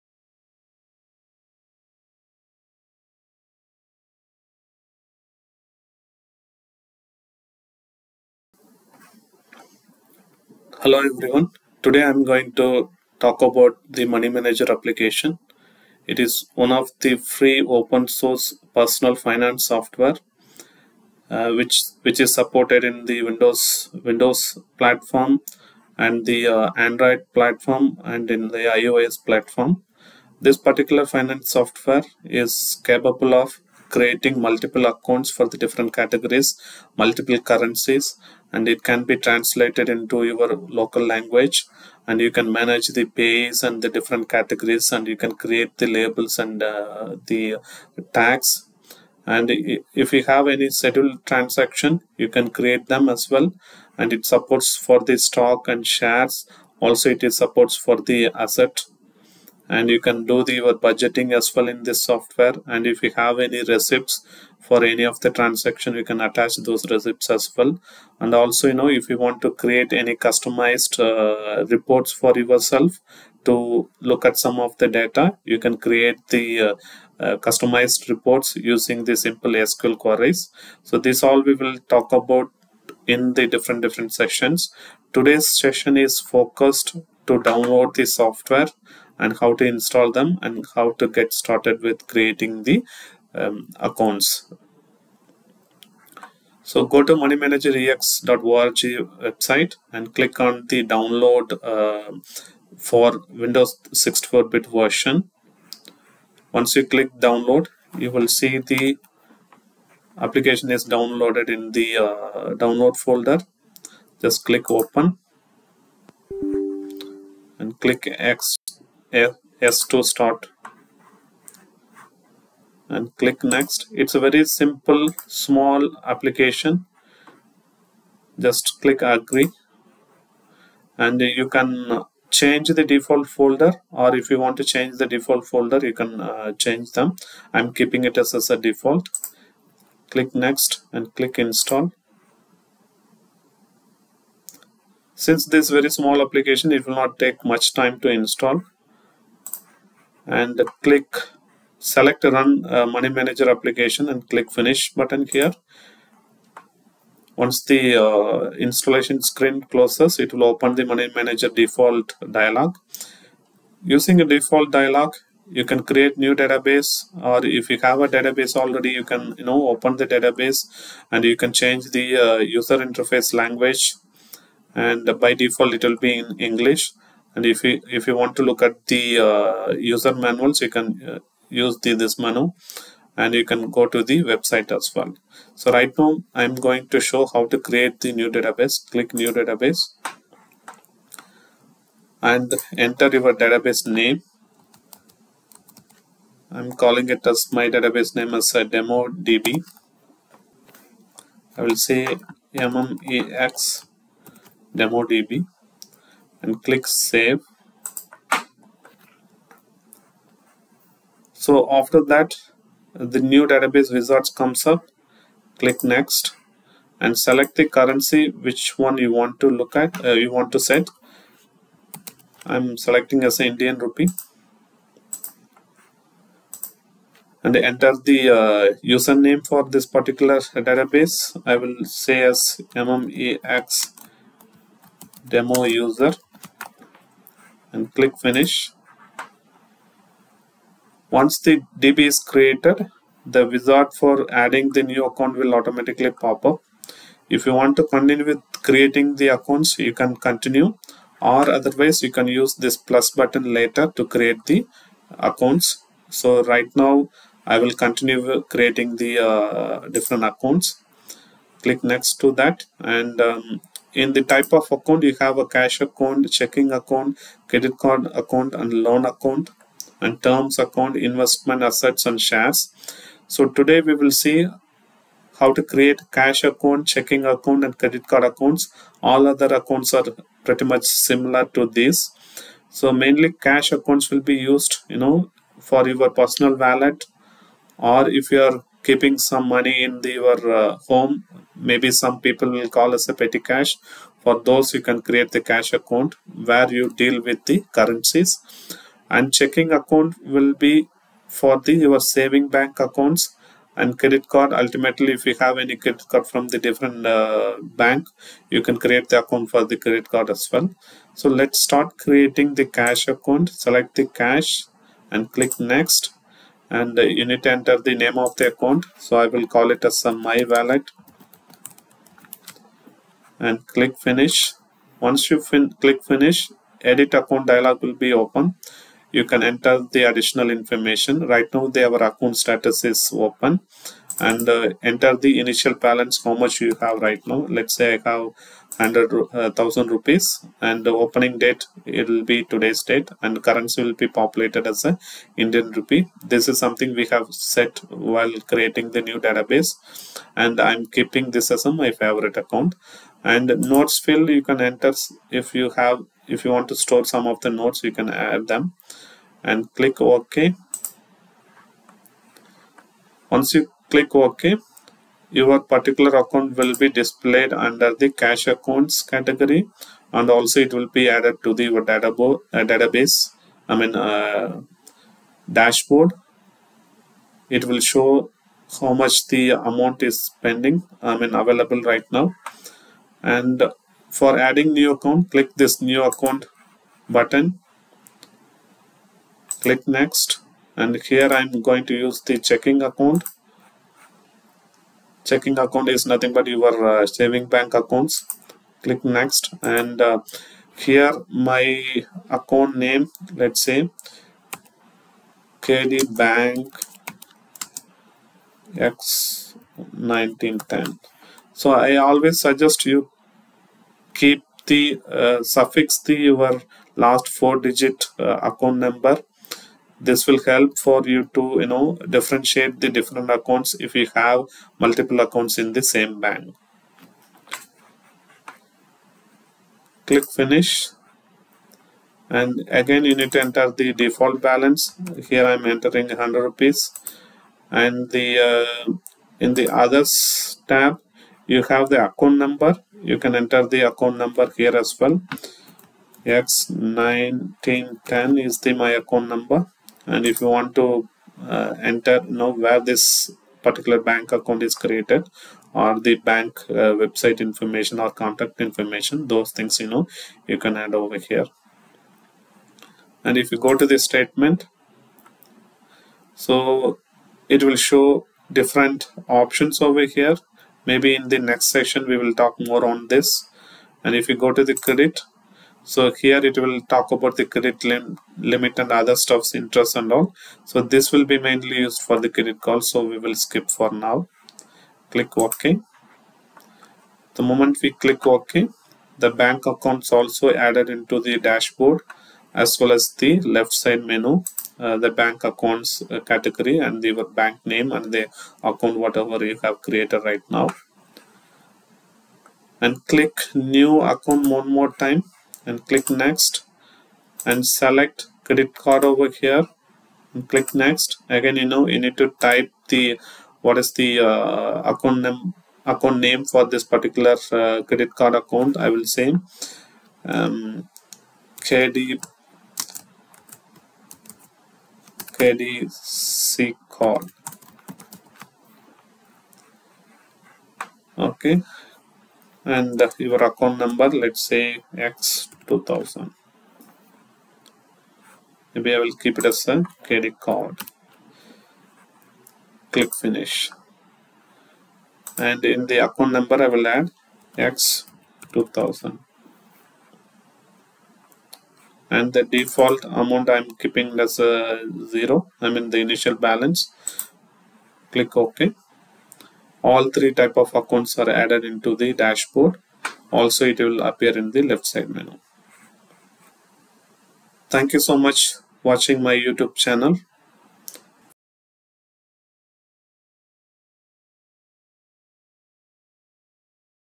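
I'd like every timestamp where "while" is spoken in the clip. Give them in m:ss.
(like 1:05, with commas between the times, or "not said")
5:48.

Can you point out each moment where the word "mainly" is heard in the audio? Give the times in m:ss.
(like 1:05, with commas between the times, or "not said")
4:42, 8:01.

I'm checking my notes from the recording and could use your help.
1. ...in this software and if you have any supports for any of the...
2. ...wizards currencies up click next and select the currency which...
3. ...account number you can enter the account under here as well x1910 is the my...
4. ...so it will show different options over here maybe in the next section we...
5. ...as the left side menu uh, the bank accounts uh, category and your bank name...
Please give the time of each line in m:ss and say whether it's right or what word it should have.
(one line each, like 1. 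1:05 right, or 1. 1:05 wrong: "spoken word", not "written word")
1. 1:01 wrong: "receipts", not "supports"
2. 3:33 wrong: "comes", not "currencies"
3. 7:22 wrong: "number", not "under"
4. 7:46 right
5. 8:12 right.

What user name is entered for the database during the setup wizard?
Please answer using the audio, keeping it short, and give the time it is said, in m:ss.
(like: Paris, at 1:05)
mmex demo user, at 3:52.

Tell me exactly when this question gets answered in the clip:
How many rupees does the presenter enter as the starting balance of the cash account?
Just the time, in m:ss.
5:38.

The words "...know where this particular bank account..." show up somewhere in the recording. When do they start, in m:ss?
7:32.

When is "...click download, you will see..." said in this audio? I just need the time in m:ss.
1:46.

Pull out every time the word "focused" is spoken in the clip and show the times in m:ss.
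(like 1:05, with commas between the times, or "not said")
1:26.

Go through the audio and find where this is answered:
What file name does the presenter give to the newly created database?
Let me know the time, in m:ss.
3:22.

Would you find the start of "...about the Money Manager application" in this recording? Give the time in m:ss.
0:13.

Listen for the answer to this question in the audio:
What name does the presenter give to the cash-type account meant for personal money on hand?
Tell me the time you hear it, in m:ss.
5:20.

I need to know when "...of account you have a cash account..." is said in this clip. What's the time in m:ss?
4:24.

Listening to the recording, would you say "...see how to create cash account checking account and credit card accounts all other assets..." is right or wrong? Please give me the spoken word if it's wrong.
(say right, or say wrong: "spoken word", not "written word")
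wrong: "accounts", not "assets".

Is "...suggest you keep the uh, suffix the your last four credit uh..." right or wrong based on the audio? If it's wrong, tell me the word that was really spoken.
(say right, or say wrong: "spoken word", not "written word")
wrong: "digit", not "credit".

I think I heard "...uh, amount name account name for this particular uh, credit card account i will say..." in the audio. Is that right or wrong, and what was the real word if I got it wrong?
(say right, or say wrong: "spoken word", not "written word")
wrong: "account", not "amount".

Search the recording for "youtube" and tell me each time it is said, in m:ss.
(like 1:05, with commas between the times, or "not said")
9:29.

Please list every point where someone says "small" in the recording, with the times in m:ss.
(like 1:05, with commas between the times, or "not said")
2:05, 2:25.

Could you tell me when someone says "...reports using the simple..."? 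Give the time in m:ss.
1:18.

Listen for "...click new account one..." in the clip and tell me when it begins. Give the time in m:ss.
8:23.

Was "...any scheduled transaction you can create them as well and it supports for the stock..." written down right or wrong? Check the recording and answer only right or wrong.
right.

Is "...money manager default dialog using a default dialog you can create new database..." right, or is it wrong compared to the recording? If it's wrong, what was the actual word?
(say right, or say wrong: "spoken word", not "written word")
right.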